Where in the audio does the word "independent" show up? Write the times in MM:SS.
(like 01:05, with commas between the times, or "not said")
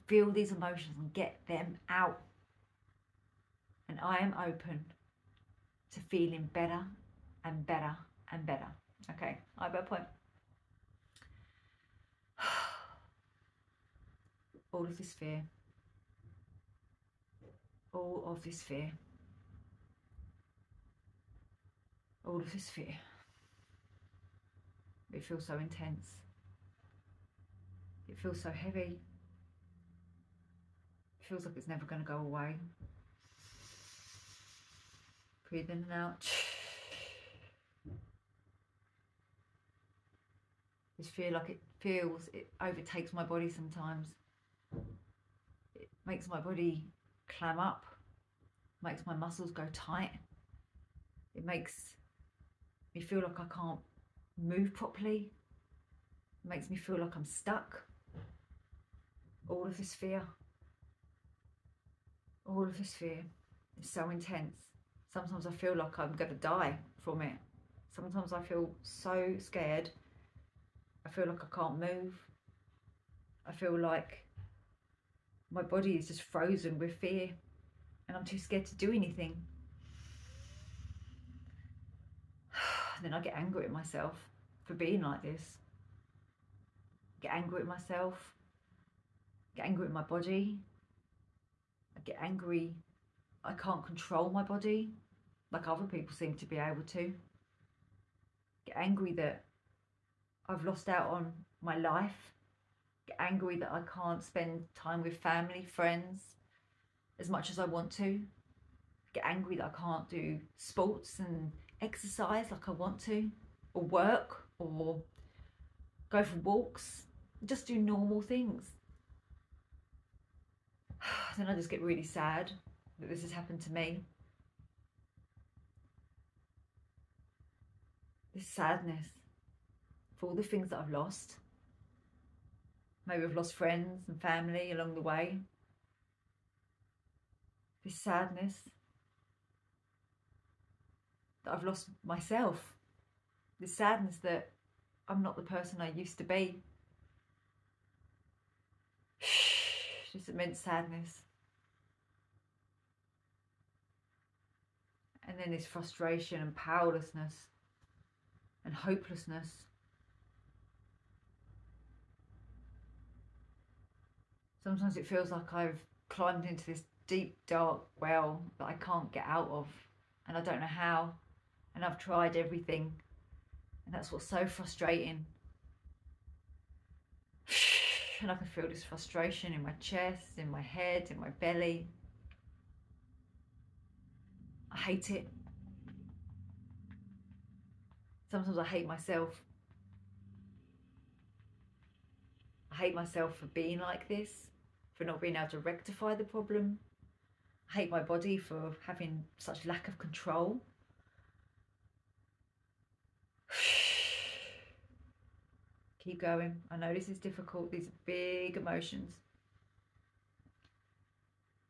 not said.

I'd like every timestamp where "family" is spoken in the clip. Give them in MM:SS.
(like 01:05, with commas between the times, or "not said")
01:45, 02:14.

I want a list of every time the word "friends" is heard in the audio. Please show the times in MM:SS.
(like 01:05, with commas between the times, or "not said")
01:45, 02:13.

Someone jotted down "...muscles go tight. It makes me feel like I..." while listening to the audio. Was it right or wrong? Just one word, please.
right.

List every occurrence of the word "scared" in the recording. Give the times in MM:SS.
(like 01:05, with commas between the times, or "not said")
01:09, 01:18.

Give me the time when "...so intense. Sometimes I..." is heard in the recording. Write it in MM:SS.
01:03.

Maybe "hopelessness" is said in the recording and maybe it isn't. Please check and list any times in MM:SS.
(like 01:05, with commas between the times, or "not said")
02:38.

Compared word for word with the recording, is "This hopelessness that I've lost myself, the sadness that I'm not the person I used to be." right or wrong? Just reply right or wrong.
wrong.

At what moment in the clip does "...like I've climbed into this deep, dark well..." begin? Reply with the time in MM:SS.
02:45.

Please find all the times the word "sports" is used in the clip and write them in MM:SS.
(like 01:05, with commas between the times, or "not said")
01:50.